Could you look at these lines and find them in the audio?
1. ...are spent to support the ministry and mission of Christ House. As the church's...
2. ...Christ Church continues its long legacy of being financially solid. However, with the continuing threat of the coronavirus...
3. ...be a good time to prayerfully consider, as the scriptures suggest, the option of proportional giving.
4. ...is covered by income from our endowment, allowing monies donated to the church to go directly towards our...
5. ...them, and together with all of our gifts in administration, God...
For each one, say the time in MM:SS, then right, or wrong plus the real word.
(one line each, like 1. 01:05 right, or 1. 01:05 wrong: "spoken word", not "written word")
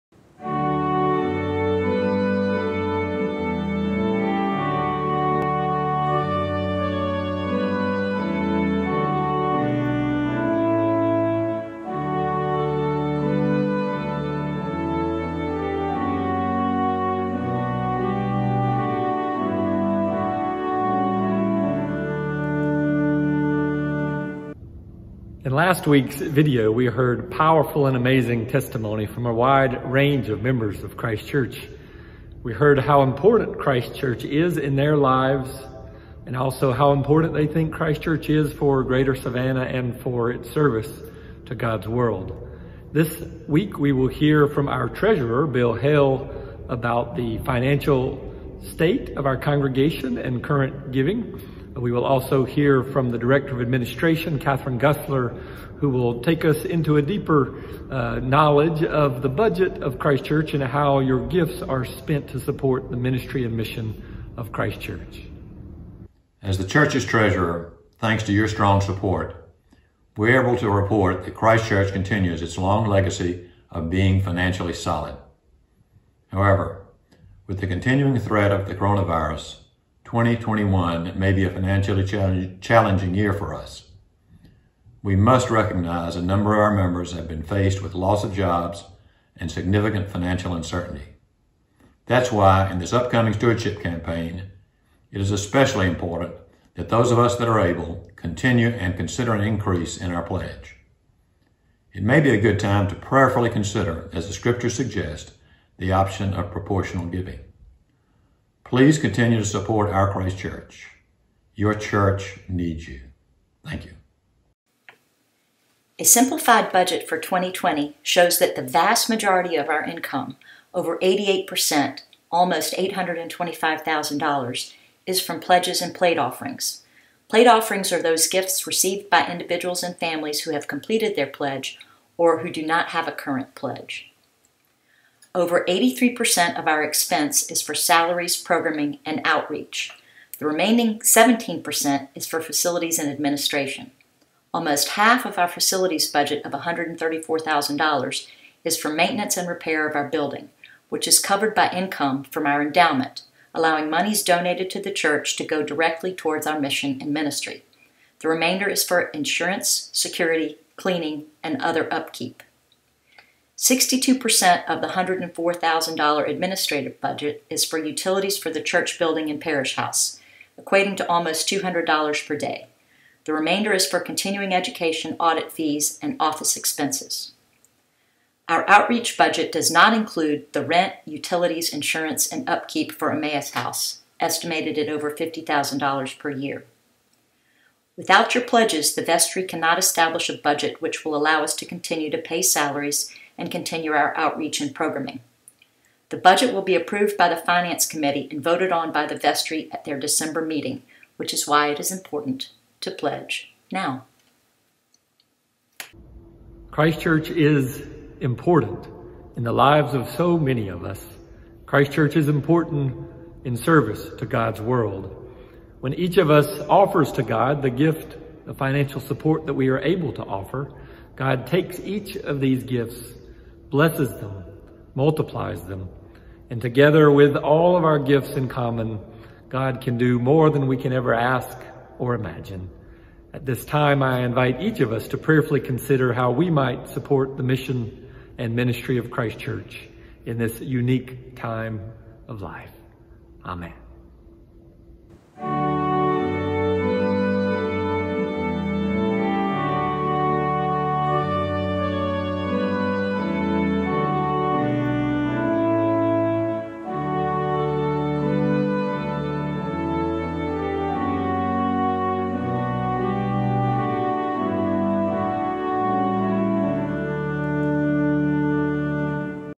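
1. 01:01 wrong: "Church", not "House"
2. 01:11 right
3. 01:42 right
4. 02:31 right
5. 03:45 wrong: "common", not "administration".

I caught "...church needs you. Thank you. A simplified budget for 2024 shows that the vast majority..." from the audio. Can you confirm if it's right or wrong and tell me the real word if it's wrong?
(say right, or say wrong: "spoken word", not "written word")
wrong: "2020", not "2024".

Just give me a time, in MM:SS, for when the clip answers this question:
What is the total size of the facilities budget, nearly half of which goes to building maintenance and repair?
02:26.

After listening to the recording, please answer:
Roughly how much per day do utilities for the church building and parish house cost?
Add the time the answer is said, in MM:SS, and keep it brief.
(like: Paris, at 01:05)
$200, at 02:51.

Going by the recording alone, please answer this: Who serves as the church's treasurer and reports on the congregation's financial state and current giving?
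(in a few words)
Bill Hale.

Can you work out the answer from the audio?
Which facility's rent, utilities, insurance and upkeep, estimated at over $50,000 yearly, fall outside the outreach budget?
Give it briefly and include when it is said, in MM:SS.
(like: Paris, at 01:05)
Emmaus House, at 03:03.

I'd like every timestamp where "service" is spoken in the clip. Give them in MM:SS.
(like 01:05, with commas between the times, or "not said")
00:40, 03:33.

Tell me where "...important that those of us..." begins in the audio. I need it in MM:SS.
01:35.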